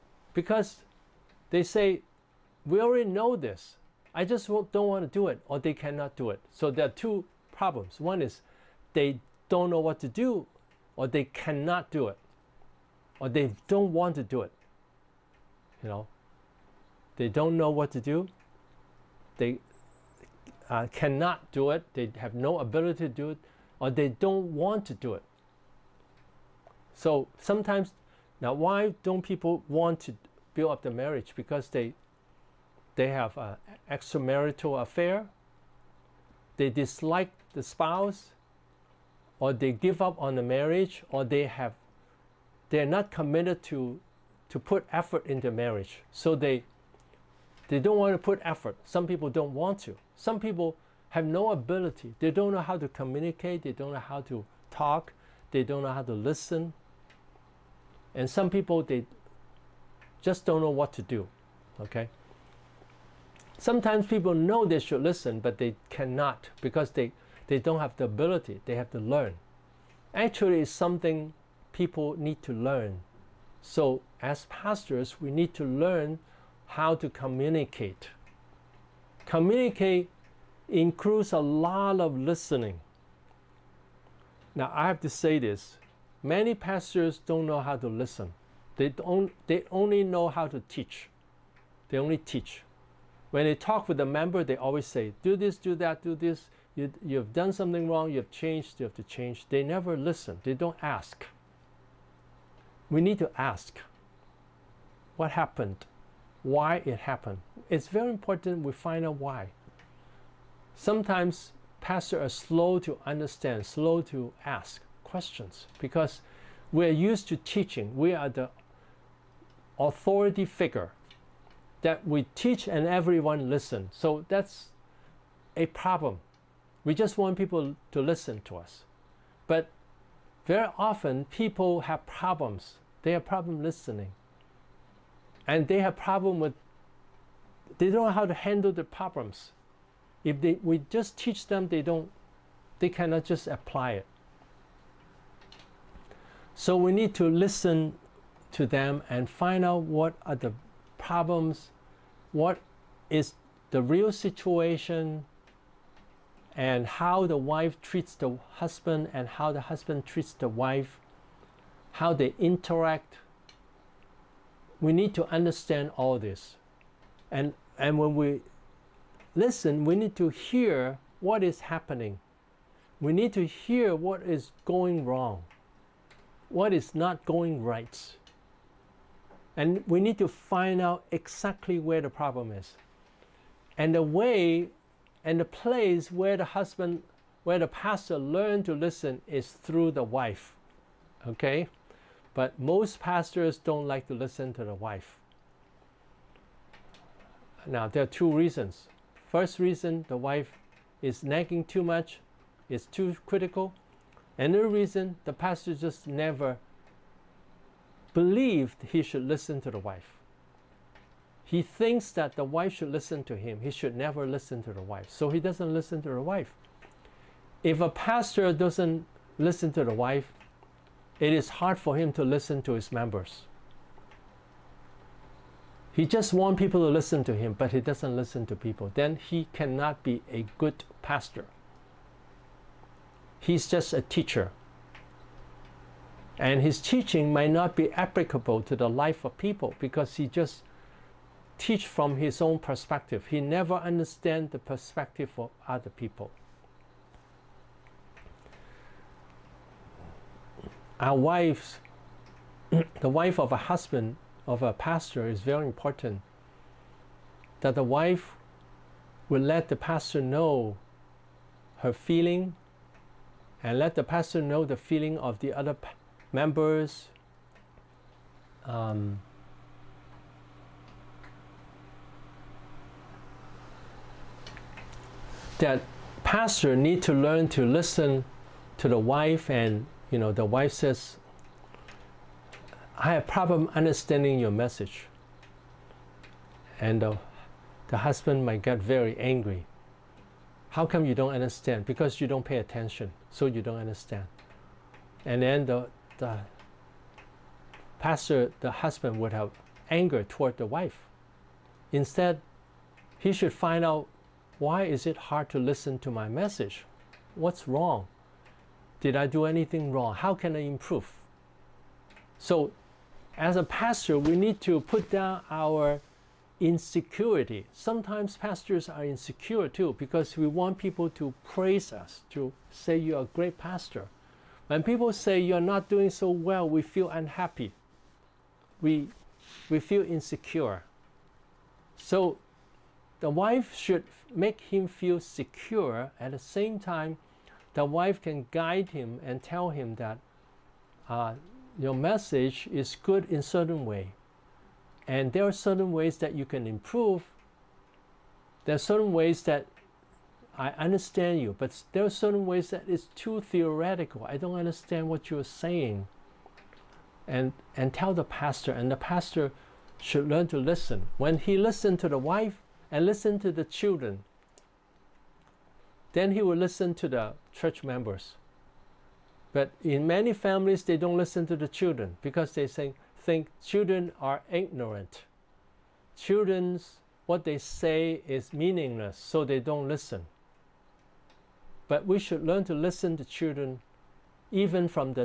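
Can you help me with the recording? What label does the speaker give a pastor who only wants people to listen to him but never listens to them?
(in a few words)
Just a teacher.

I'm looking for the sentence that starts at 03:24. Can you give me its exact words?
And the reason, the pastor just never believed he should listen to the wife.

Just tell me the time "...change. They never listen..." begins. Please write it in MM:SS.
01:39.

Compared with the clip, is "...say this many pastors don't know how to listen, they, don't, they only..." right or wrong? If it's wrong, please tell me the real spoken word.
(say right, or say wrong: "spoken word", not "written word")
right.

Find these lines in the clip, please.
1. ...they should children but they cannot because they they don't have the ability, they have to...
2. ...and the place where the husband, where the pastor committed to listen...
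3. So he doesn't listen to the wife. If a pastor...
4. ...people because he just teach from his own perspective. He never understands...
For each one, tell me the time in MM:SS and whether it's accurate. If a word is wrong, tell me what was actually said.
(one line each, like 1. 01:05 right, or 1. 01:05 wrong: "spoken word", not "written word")
1. 01:04 wrong: "listen", not "children"
2. 03:05 wrong: "learned", not "committed"
3. 03:35 right
4. 03:59 right.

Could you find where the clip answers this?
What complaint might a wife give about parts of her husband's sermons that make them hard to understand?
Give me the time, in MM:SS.
05:53.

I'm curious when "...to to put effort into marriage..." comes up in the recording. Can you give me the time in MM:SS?
00:43.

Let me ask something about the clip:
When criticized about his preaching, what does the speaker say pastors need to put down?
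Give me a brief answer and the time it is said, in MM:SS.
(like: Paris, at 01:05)
Insecurity, at 05:16.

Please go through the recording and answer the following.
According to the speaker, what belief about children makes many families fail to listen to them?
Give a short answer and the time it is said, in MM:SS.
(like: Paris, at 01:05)
Children are ignorant, at 06:13.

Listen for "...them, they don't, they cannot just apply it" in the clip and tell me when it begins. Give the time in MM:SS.
02:21.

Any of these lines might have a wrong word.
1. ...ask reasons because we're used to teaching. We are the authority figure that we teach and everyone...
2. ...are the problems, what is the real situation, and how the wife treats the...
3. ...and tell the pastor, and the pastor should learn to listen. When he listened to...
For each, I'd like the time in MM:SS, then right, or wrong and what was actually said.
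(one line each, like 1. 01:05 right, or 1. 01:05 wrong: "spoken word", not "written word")
1. 01:54 wrong: "questions", not "reasons"
2. 02:30 right
3. 05:57 right.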